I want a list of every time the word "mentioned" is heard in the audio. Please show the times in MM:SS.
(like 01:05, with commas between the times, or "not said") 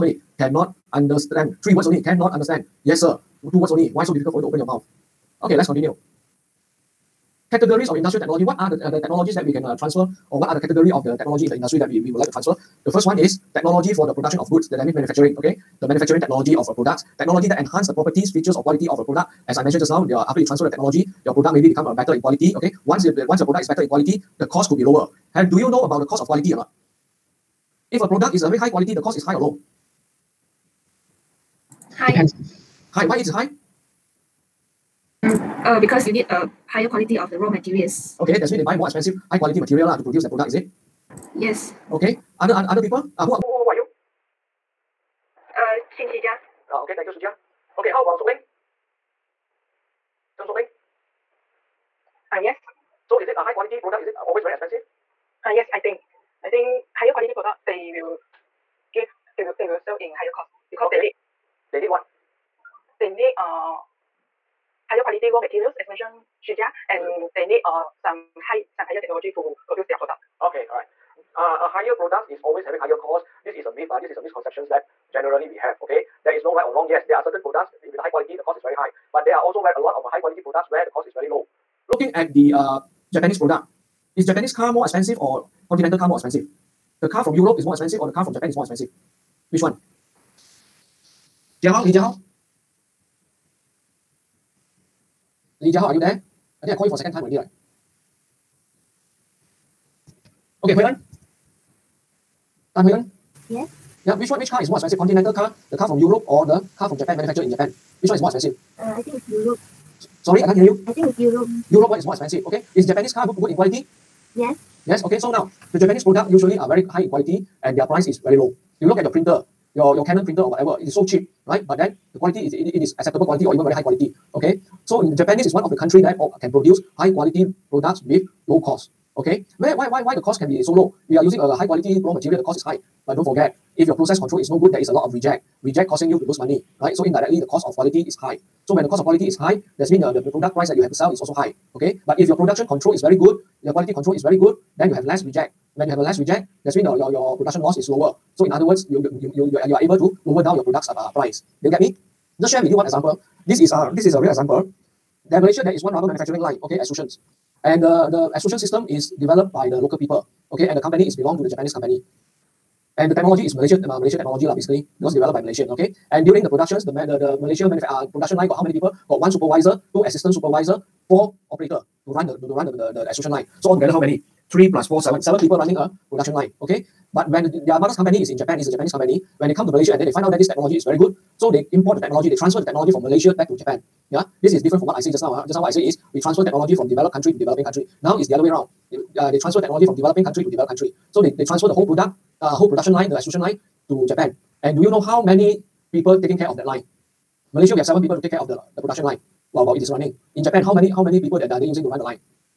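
00:19, 01:05.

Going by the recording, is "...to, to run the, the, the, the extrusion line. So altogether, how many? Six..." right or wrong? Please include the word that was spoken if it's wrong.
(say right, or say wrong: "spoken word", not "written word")
wrong: "Three", not "Six".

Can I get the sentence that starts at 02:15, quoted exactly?
Reject causing you to lose money, right?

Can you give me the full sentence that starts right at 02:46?
And during the productions, the the, the Malaysia uh, production line got how many people?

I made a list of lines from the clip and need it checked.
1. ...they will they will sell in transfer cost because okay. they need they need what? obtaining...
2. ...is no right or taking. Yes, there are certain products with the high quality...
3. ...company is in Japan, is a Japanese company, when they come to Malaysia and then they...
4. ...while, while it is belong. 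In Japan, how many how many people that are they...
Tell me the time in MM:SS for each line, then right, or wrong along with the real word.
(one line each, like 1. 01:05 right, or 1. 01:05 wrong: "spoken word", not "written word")
1. 00:59 wrong: "higher", not "transfer"
2. 01:16 wrong: "wrong", not "taking"
3. 02:57 right
4. 03:19 wrong: "running", not "belong".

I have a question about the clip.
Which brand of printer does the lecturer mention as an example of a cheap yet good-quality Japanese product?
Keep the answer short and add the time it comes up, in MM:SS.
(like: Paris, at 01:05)
Canon, at 02:00.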